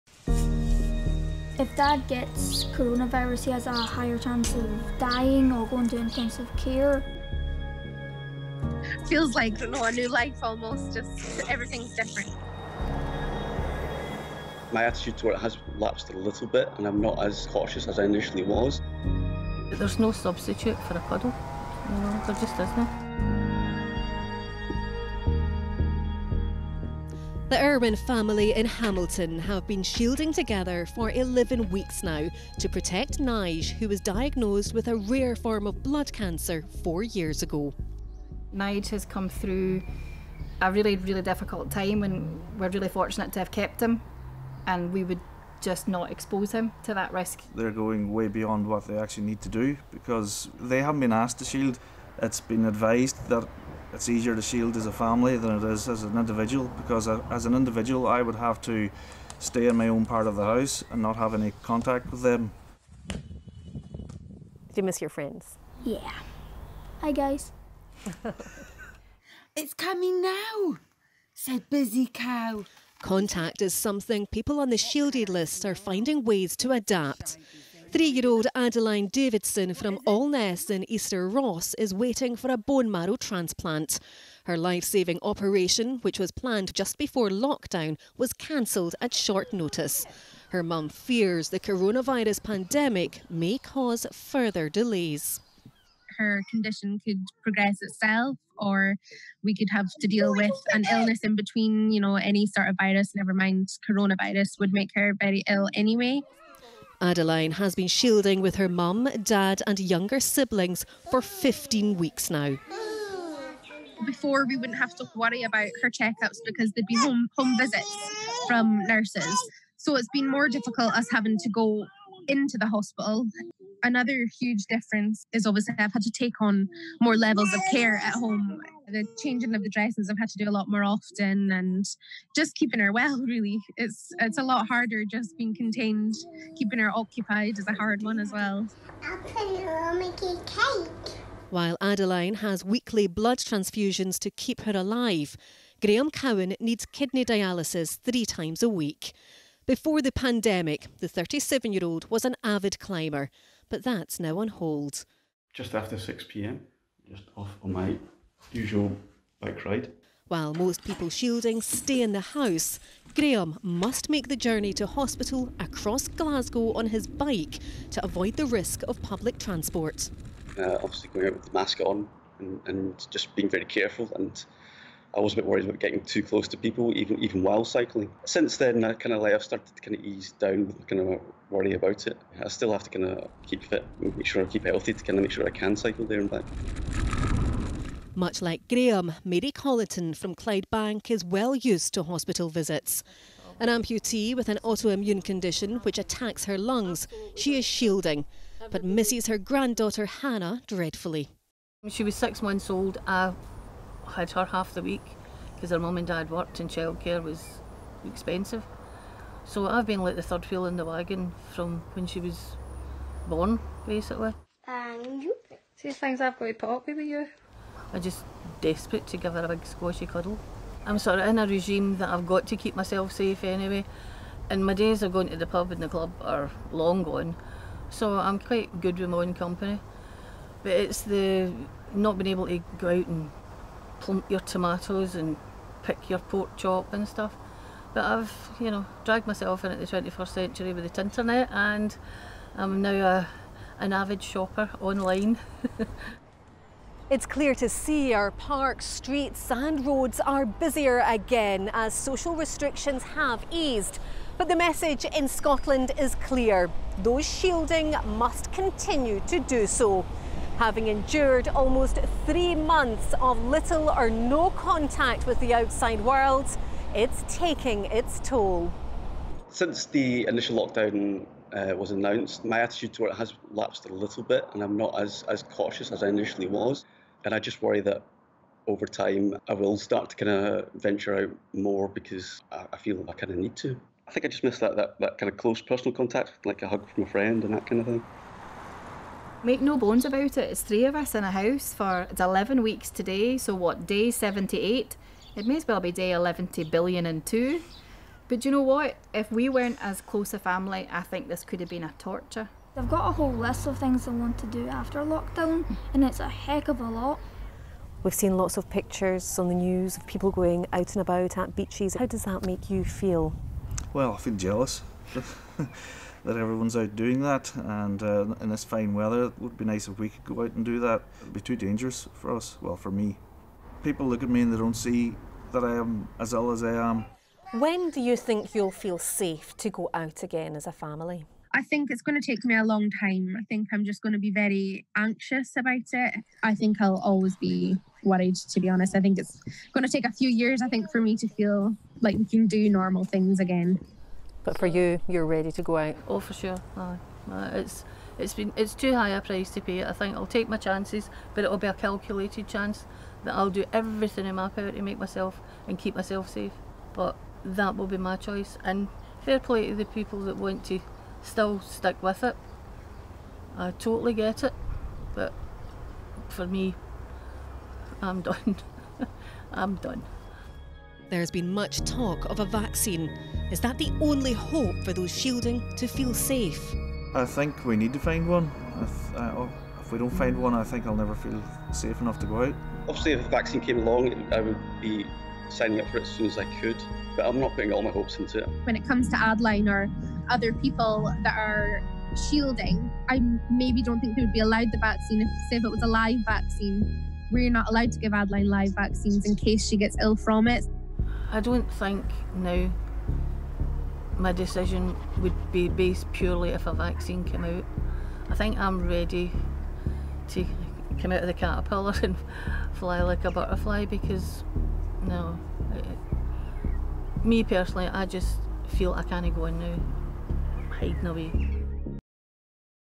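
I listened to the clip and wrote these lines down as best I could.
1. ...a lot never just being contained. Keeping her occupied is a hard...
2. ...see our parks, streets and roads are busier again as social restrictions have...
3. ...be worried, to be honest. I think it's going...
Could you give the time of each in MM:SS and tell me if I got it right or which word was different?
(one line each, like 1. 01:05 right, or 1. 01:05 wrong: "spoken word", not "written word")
1. 02:14 wrong: "harder", not "never"
2. 04:07 right
3. 05:37 right.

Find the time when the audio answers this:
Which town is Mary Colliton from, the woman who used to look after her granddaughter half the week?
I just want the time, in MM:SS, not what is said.
03:10.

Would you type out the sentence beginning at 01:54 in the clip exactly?
Before, we wouldn't have to worry about her checkups because there'd be home, home visits from nurses.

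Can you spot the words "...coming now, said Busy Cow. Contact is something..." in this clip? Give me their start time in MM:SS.
01:09.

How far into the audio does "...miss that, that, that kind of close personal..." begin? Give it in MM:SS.
04:44.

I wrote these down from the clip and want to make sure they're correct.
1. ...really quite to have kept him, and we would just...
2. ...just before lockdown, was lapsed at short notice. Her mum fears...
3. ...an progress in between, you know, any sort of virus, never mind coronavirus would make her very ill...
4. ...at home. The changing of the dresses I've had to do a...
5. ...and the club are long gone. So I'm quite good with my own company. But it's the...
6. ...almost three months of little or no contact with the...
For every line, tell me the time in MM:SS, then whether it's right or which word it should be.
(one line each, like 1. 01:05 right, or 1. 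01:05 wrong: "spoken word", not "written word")
1. 00:42 wrong: "fortunate", not "quite"
2. 01:26 wrong: "cancelled", not "lapsed"
3. 01:40 wrong: "illness", not "progress"
4. 02:07 right
5. 03:45 right
6. 04:21 right.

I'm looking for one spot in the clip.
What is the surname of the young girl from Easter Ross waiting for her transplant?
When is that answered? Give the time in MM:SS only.
01:19.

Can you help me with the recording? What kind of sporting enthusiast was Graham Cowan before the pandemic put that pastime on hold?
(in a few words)
Climber.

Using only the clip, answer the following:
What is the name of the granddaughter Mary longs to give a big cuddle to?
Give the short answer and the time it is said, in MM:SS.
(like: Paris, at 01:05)
Hannah, at 03:20.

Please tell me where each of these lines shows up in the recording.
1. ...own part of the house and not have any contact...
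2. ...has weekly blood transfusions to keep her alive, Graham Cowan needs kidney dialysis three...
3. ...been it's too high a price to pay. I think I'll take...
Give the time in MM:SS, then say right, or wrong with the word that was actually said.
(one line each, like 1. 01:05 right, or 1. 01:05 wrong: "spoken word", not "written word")
1. 00:59 right
2. 02:22 right
3. 05:48 right.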